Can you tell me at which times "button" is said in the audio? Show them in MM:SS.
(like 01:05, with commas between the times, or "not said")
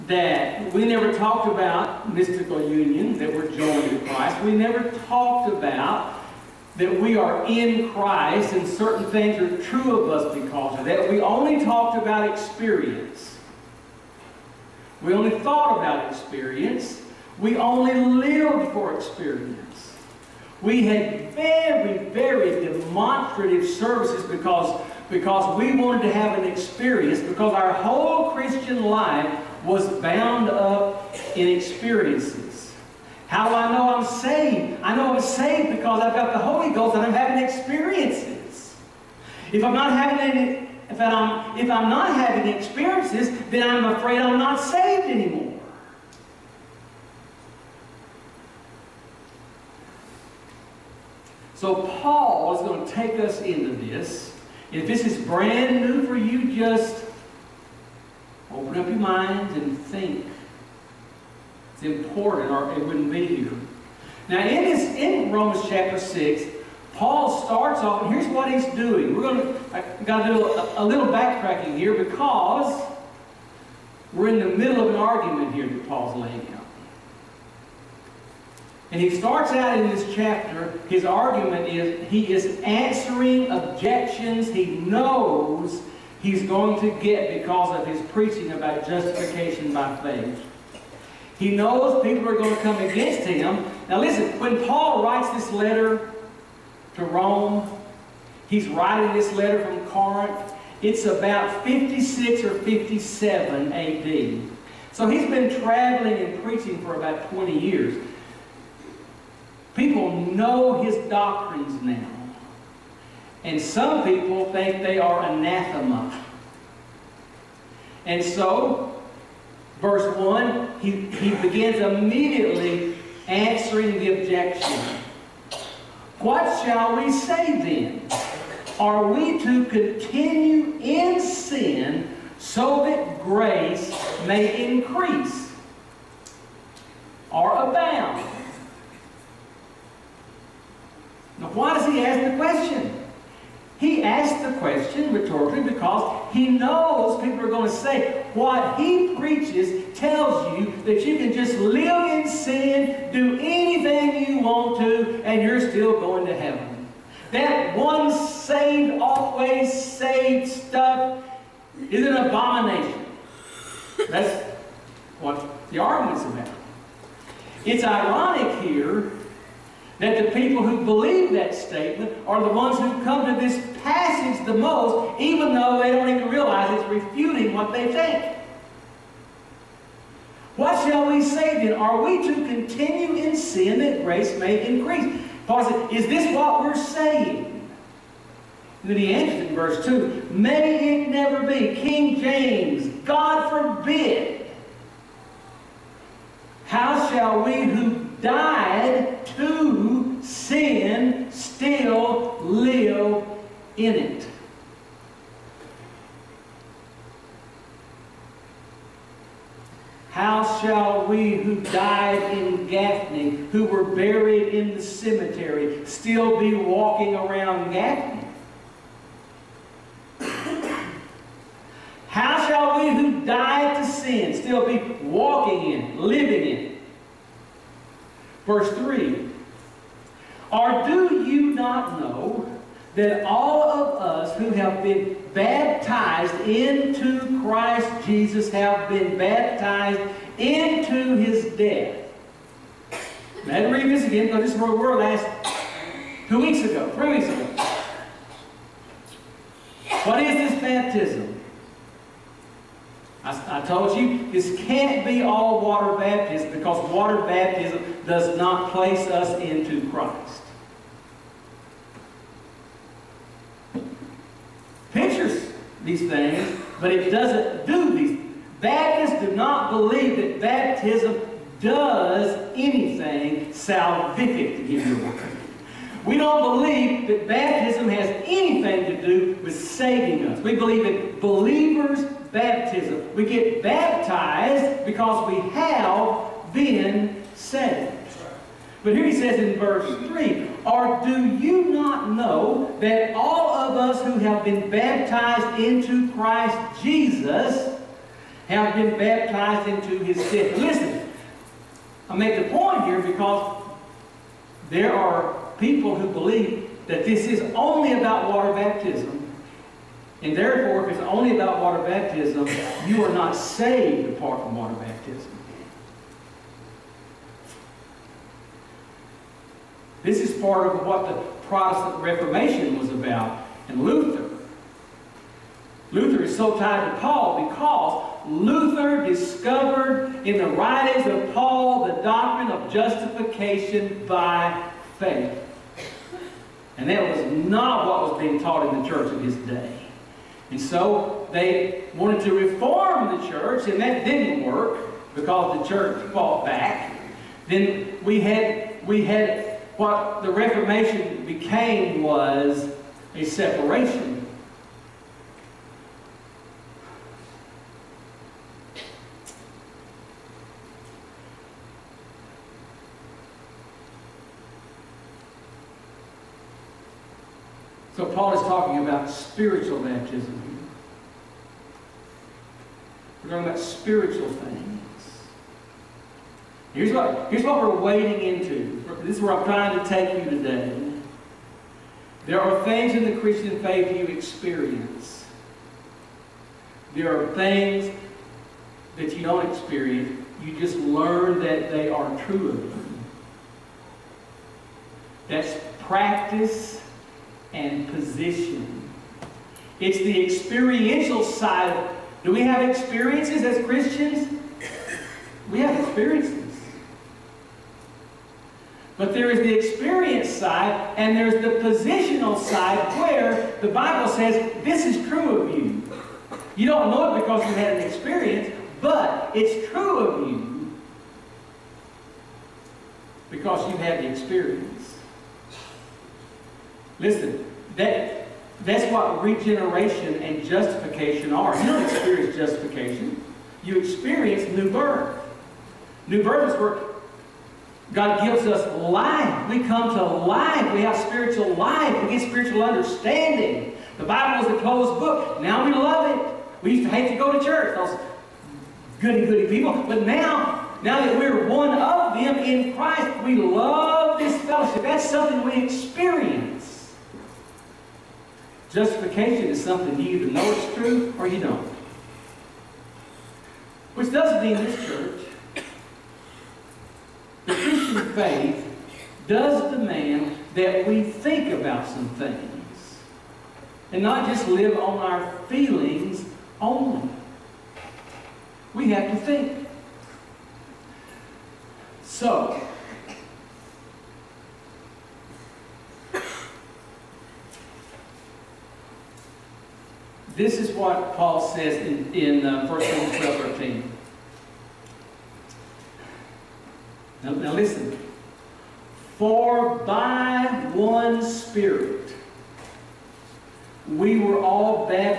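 not said.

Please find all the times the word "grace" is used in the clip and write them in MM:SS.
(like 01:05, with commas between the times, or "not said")
02:13, 03:04.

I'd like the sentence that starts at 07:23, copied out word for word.
The Bible is a closed book.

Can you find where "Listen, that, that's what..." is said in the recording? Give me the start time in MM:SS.
07:06.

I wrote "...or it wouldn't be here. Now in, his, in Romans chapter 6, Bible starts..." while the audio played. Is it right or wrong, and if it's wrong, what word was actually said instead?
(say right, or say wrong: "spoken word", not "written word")
wrong: "Paul", not "Bible".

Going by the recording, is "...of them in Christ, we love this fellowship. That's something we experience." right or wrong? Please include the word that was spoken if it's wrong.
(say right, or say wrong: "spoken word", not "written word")
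right.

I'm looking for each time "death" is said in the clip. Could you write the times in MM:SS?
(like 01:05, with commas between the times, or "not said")
04:01, 05:00.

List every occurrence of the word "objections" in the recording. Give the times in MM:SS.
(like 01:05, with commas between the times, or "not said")
01:23, 02:04.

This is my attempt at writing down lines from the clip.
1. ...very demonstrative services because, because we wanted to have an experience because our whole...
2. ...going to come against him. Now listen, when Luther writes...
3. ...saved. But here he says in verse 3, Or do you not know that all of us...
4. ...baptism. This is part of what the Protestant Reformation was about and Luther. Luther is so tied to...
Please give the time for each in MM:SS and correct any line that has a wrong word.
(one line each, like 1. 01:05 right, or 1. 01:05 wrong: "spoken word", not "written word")
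1. 00:22 right
2. 01:32 wrong: "Paul", not "Luther"
3. 04:47 right
4. 05:14 right.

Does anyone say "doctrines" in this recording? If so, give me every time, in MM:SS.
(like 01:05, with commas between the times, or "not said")
01:51, 05:32.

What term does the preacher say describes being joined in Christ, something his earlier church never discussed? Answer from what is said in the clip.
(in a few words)
mystical union.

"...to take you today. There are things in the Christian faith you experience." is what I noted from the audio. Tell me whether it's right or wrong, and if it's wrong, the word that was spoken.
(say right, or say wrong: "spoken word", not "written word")
right.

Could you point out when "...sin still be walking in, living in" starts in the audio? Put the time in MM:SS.
03:43.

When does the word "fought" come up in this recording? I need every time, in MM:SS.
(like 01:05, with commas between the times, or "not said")
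05:46.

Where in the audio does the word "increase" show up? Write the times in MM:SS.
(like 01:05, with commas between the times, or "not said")
02:14, 03:04.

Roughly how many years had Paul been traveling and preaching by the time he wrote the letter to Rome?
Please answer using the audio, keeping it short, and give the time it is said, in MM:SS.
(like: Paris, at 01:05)
20, at 01:47.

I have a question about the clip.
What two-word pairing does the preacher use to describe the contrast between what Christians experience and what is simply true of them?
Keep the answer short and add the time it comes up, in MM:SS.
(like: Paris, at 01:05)
practice and position, at 06:35.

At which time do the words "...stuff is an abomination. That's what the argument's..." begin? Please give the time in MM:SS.
02:40.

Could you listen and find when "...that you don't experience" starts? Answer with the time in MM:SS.
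06:28.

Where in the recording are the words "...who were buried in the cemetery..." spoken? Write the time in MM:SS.
03:33.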